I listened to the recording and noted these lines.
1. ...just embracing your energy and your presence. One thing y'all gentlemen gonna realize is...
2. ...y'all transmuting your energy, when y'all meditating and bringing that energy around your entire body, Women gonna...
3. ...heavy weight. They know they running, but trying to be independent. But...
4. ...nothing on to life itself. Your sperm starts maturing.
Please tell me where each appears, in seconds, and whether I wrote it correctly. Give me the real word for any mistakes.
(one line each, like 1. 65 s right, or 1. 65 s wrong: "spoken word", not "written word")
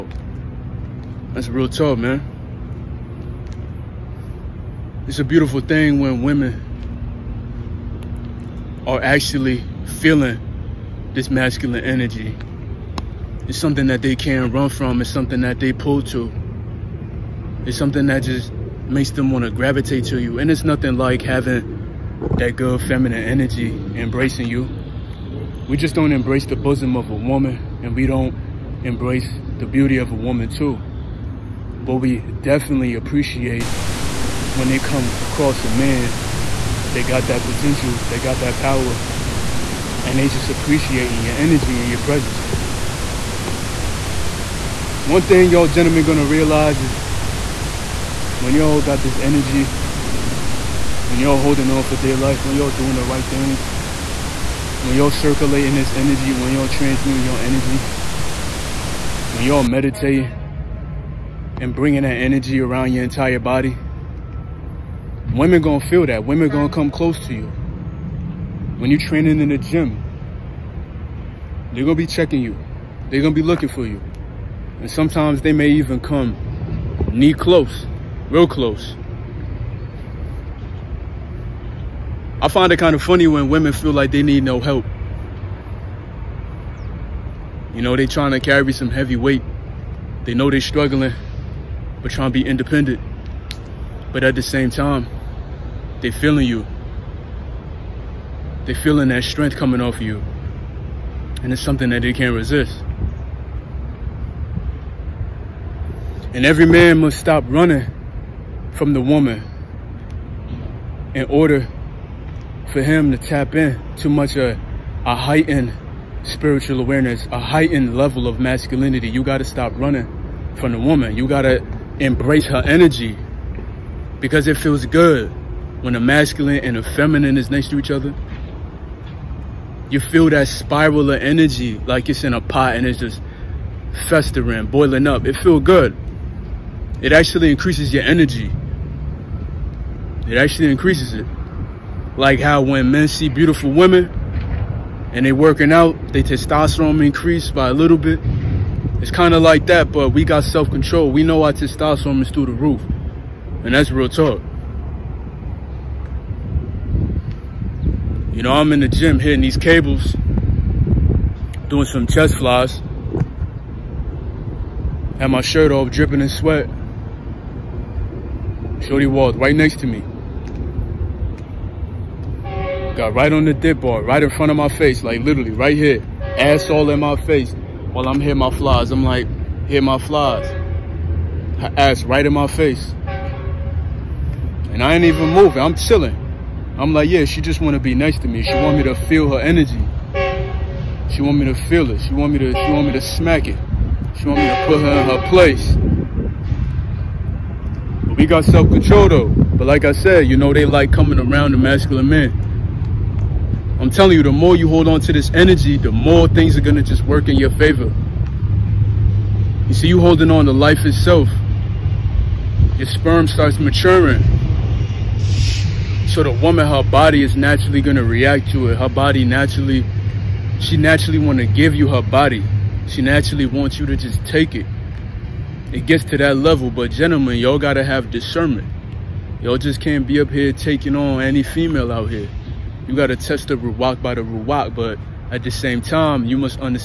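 1. 40 s wrong: "appreciating", not "embracing"
2. 56 s right
3. 88 s wrong: "struggling", not "running"
4. 210 s wrong: "holding", not "nothing".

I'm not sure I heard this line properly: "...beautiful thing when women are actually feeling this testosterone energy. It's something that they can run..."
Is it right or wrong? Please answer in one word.
wrong.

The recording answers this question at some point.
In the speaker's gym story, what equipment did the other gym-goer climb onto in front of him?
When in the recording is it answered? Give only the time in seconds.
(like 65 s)
173 s.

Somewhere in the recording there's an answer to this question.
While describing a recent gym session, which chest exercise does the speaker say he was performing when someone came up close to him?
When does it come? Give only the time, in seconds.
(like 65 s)
162 s.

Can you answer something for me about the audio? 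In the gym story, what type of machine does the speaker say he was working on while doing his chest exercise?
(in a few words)
cables.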